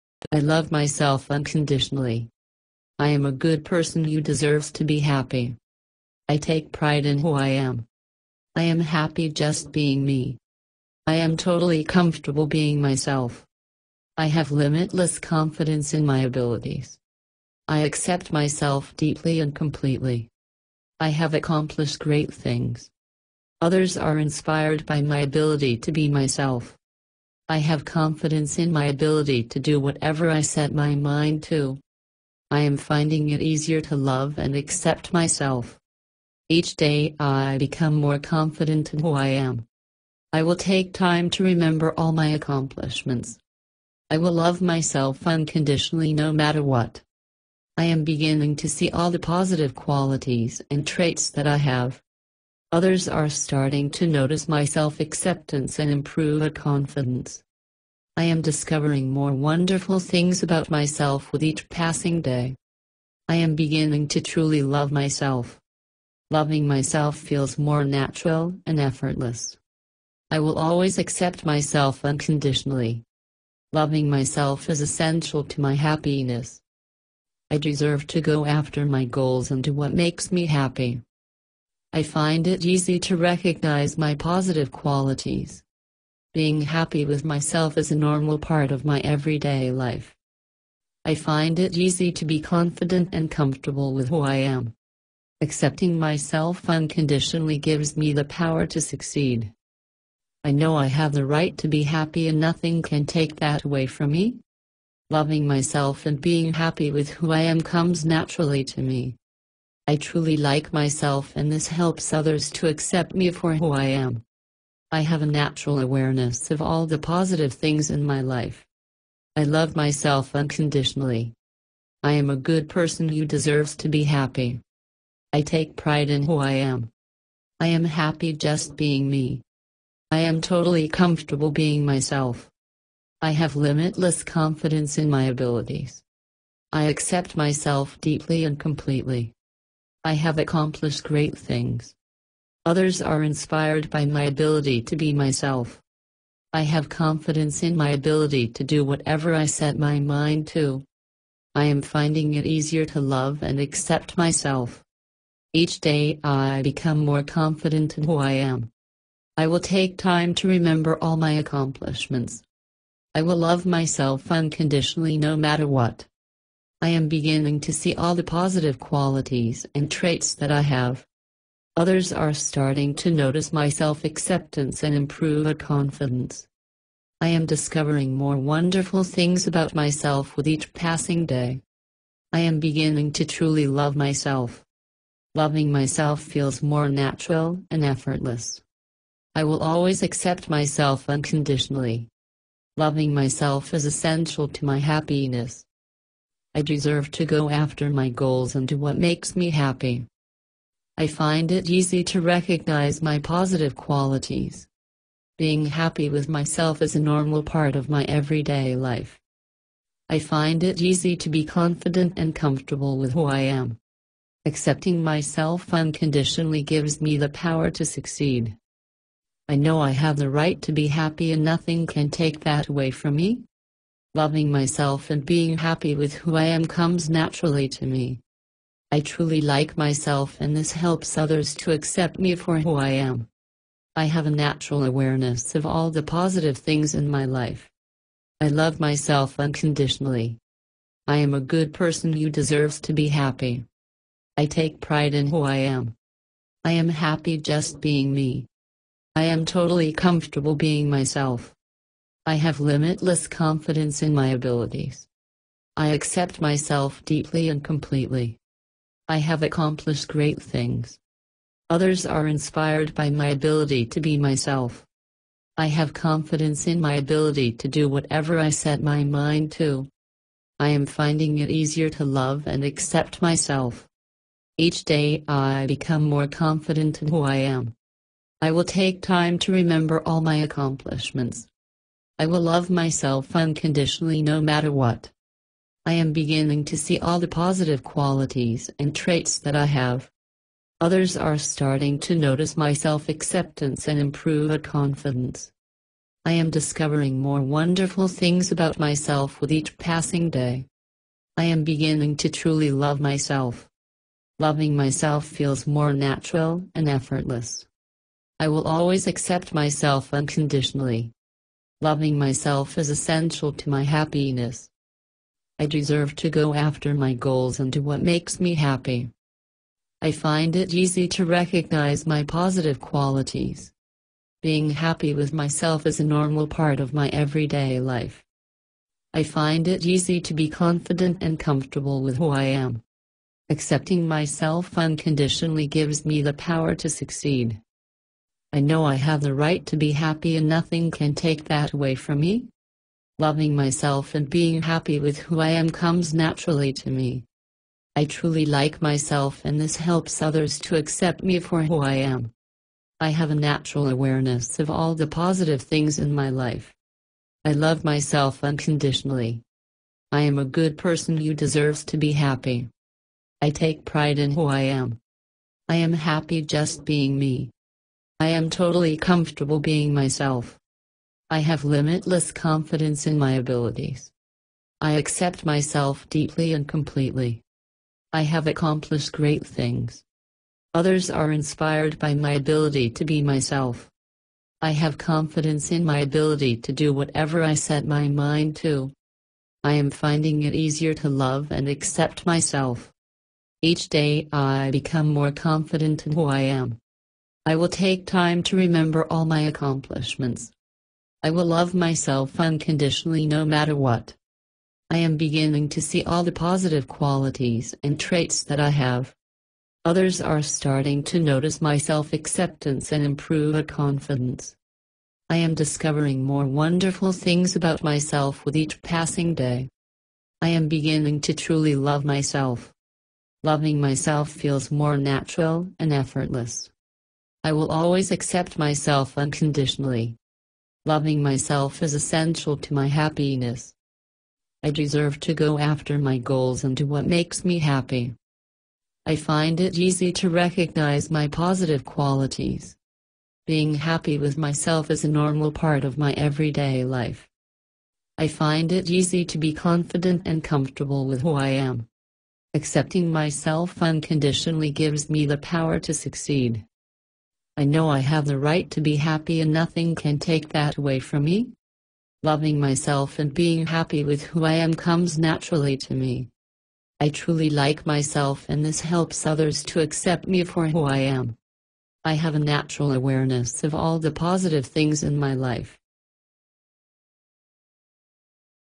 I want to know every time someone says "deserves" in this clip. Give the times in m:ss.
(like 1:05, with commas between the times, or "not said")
0:04, 1:17, 2:03, 3:16, 4:02, 5:15, 6:01, 7:14.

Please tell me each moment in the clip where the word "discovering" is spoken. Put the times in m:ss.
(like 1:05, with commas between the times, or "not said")
0:58, 2:57, 4:56, 6:55.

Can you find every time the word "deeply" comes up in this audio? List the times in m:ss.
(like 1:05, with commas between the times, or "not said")
0:18, 2:17, 4:17, 6:16.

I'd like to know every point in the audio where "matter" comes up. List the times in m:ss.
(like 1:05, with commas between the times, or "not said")
0:46, 2:45, 4:44, 6:43.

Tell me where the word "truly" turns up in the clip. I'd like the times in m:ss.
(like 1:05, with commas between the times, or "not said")
1:04, 1:49, 3:03, 3:48, 5:02, 5:48, 7:01, 7:47.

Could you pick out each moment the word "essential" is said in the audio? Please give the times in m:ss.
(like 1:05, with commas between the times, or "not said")
1:14, 3:13, 5:12, 7:11.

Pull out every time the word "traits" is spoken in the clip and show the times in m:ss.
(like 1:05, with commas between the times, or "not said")
0:50, 2:49, 4:48, 6:47.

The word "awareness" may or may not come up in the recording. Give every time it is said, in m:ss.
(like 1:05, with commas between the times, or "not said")
1:55, 3:54, 5:53, 7:52.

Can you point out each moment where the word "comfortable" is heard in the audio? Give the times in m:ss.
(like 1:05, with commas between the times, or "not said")
0:11, 1:33, 2:10, 3:32, 4:09, 5:31, 6:08, 7:30.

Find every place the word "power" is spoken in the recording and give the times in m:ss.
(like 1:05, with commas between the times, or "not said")
1:38, 3:37, 5:36, 7:35.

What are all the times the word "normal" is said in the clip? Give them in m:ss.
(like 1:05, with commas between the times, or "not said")
1:27, 3:26, 5:26, 7:25.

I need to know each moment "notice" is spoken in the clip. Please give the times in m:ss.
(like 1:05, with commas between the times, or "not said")
0:54, 2:53, 4:52, 6:51.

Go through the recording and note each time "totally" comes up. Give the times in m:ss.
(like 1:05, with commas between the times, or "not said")
0:11, 2:10, 4:09, 6:08.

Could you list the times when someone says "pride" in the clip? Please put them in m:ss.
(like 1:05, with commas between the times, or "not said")
0:06, 2:05, 4:04, 6:03.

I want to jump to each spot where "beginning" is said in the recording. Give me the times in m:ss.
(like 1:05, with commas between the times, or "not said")
0:48, 1:03, 2:47, 3:02, 4:46, 5:01, 6:45, 7:00.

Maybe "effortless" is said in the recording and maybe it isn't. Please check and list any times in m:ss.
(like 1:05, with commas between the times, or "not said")
1:08, 3:07, 5:06, 7:05.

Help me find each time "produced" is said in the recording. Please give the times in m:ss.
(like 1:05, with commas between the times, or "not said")
not said.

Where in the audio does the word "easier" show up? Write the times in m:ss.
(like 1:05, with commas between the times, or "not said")
0:33, 2:32, 4:31, 6:30.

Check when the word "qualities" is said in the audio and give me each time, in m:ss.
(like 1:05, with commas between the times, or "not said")
0:49, 1:24, 2:48, 3:23, 4:47, 5:22, 6:46, 7:21.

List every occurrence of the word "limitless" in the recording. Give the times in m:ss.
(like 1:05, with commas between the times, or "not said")
0:14, 2:13, 4:12, 6:11.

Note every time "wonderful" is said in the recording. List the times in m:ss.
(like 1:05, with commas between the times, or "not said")
0:59, 2:58, 4:57, 6:56.